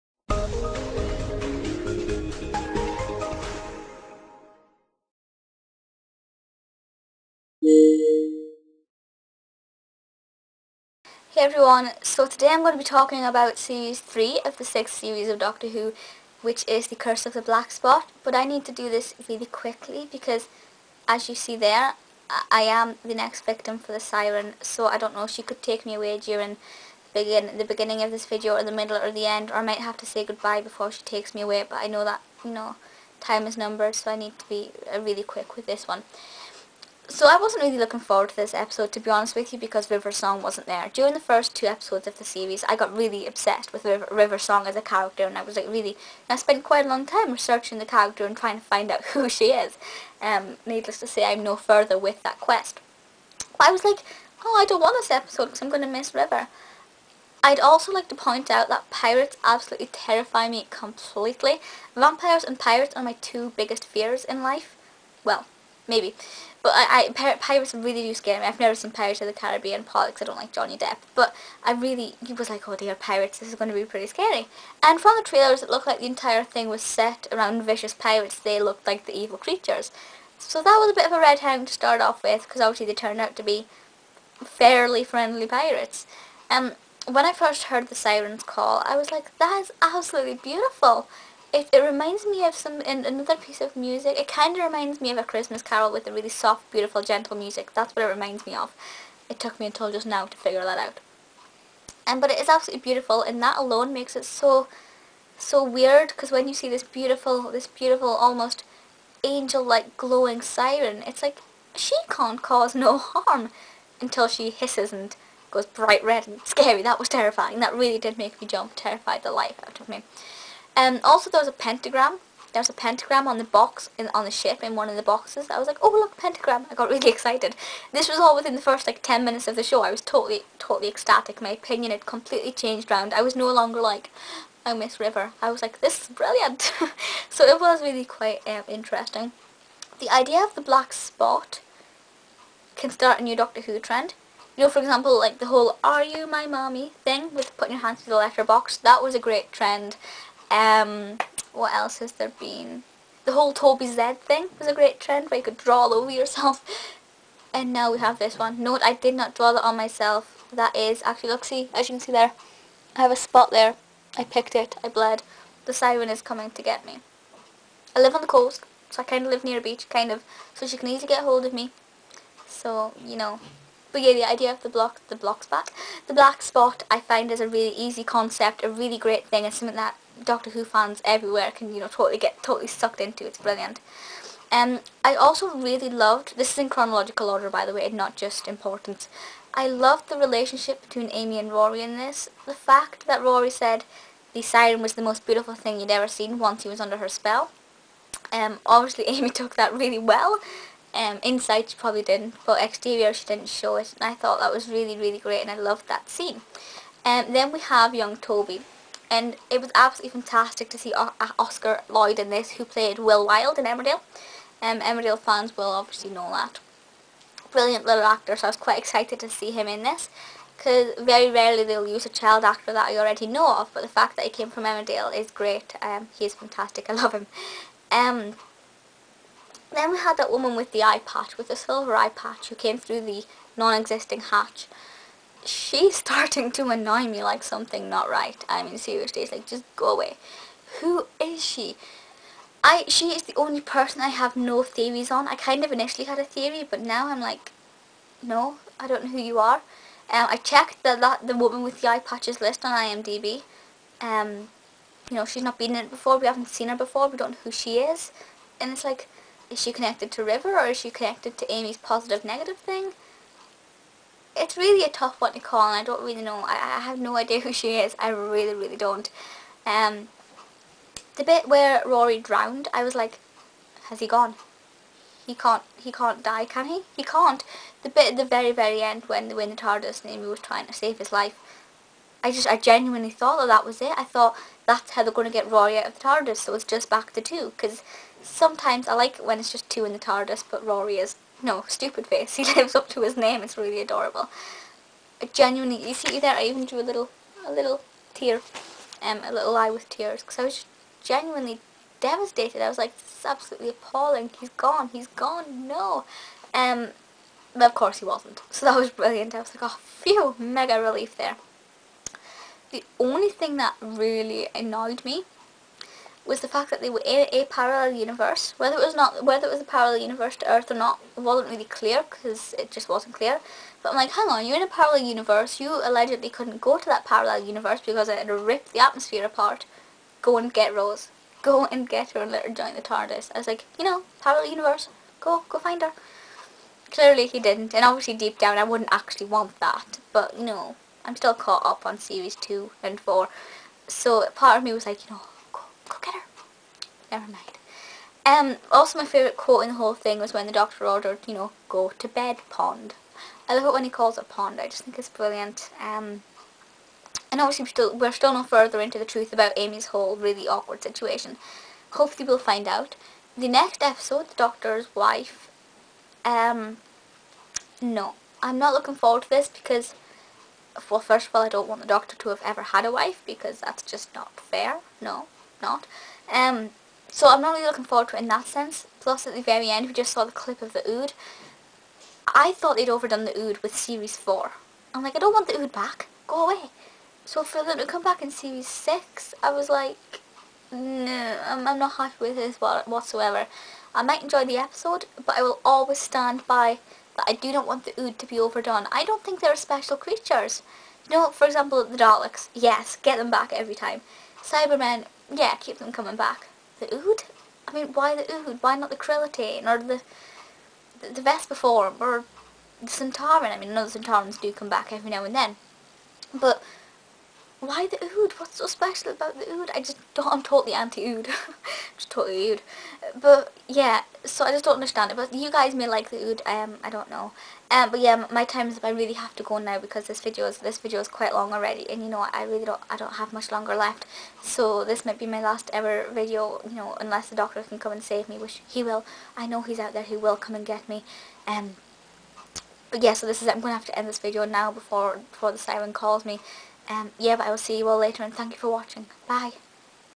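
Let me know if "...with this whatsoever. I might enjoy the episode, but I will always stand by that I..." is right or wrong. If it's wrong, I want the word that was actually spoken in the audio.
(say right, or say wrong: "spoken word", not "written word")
right.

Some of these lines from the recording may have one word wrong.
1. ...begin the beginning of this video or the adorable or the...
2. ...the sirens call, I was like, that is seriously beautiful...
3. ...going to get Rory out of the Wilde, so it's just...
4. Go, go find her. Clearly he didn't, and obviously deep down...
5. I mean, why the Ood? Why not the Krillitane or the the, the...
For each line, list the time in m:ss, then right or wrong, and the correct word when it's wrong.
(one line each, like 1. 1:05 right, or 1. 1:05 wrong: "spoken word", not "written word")
1. 0:27 wrong: "middle", not "adorable"
2. 1:27 wrong: "absolutely", not "seriously"
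3. 4:45 wrong: "TARDIS", not "Wilde"
4. 5:35 right
5. 6:47 right.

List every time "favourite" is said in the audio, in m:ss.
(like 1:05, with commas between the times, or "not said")
5:49.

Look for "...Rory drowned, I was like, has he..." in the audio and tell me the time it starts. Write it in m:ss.
4:31.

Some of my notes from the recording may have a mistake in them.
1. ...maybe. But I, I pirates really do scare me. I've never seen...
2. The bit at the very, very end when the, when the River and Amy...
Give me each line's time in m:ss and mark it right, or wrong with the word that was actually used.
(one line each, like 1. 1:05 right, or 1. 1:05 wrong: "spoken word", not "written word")
1. 1:05 right
2. 4:37 wrong: "TARDIS", not "River".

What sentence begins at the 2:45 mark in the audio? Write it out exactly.
The siren is coming to get me.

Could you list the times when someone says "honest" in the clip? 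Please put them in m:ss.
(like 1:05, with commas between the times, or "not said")
0:39.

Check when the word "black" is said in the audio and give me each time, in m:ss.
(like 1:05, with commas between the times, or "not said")
0:17, 2:20, 2:56.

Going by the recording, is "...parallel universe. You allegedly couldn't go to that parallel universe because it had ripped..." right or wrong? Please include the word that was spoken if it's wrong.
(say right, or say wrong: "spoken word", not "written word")
right.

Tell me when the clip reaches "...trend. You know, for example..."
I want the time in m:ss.
2:23.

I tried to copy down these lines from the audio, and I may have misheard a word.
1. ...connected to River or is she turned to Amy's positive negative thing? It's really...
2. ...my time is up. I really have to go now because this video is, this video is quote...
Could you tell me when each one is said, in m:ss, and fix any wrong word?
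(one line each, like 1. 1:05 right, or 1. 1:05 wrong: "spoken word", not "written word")
1. 4:19 wrong: "connected", not "turned"
2. 7:08 wrong: "quite", not "quote".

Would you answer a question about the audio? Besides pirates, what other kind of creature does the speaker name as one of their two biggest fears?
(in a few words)
Vampires.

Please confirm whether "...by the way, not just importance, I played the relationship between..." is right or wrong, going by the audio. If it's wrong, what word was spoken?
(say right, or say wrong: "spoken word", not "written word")
wrong: "loved", not "played".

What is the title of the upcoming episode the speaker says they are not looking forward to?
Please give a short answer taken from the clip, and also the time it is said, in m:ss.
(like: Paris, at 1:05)
The Doctor's Wife, at 6:04.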